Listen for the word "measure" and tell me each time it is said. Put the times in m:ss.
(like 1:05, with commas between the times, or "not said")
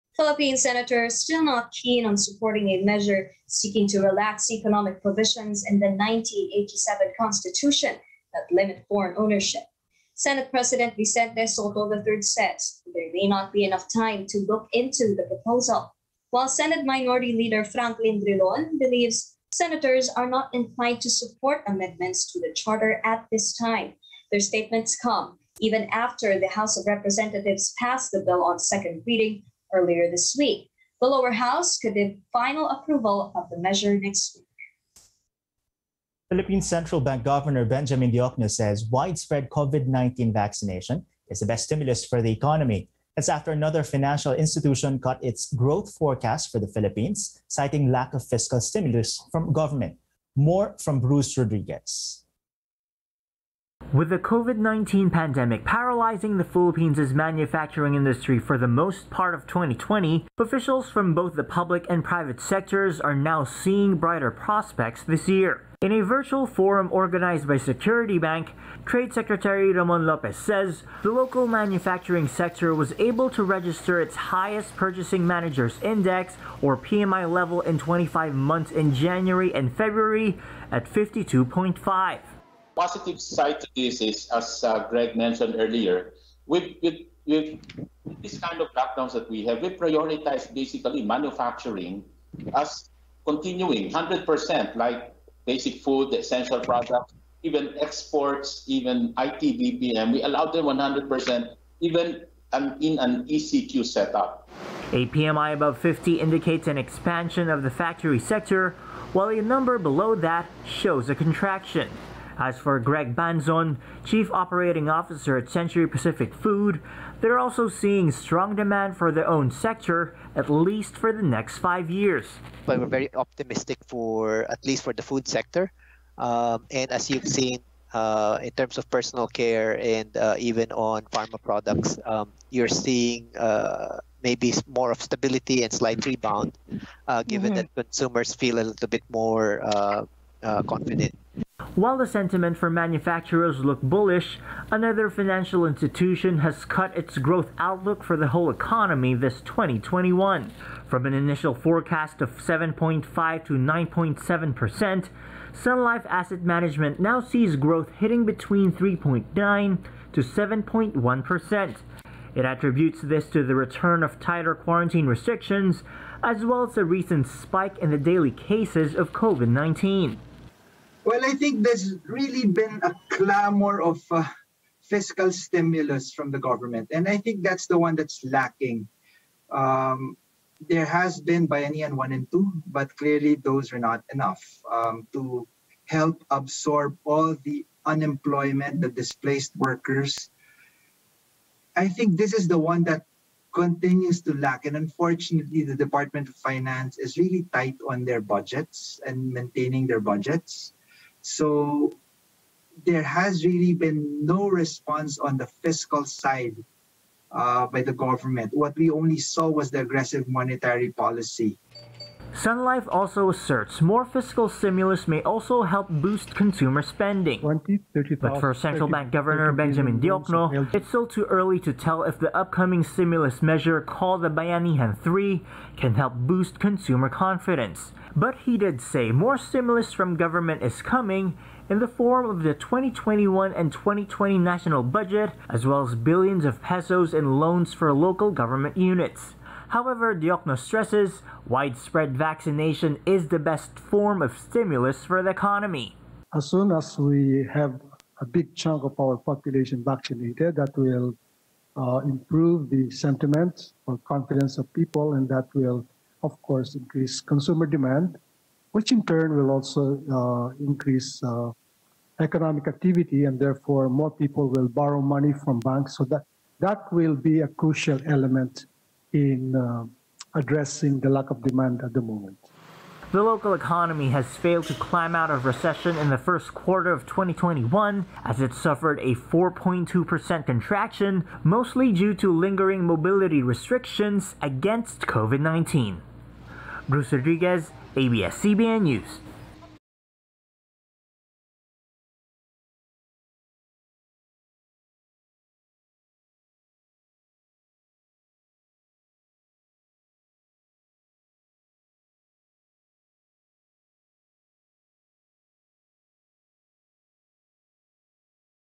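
0:02, 0:33, 3:43.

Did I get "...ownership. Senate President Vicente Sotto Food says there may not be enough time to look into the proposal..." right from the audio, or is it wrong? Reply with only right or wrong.
wrong.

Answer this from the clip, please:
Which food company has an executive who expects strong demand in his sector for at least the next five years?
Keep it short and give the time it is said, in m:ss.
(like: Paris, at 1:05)
Century Pacific Food, at 1:55.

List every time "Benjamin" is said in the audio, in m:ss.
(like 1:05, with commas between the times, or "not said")
0:37, 3:39.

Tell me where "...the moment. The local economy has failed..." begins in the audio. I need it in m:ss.
4:31.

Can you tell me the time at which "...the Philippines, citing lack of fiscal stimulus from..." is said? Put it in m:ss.
0:46.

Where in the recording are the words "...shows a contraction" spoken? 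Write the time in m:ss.
1:50.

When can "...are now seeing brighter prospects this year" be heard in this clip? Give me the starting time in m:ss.
1:03.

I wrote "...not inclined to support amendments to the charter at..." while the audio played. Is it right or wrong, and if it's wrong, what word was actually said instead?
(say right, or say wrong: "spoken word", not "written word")
right.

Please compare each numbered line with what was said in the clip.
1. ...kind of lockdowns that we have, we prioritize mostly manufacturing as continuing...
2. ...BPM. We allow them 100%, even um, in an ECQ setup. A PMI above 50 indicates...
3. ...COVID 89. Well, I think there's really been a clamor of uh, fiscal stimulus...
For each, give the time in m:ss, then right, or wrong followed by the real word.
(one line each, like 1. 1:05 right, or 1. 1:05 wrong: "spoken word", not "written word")
1. 1:28 wrong: "basically", not "mostly"
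2. 1:39 right
3. 2:49 wrong: "19", not "89".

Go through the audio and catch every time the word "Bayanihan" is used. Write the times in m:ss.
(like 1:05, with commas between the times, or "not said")
3:01, 3:44.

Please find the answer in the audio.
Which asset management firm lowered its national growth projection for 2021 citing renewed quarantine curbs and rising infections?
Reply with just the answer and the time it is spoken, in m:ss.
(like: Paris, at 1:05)
Sun Life Asset Management, at 2:35.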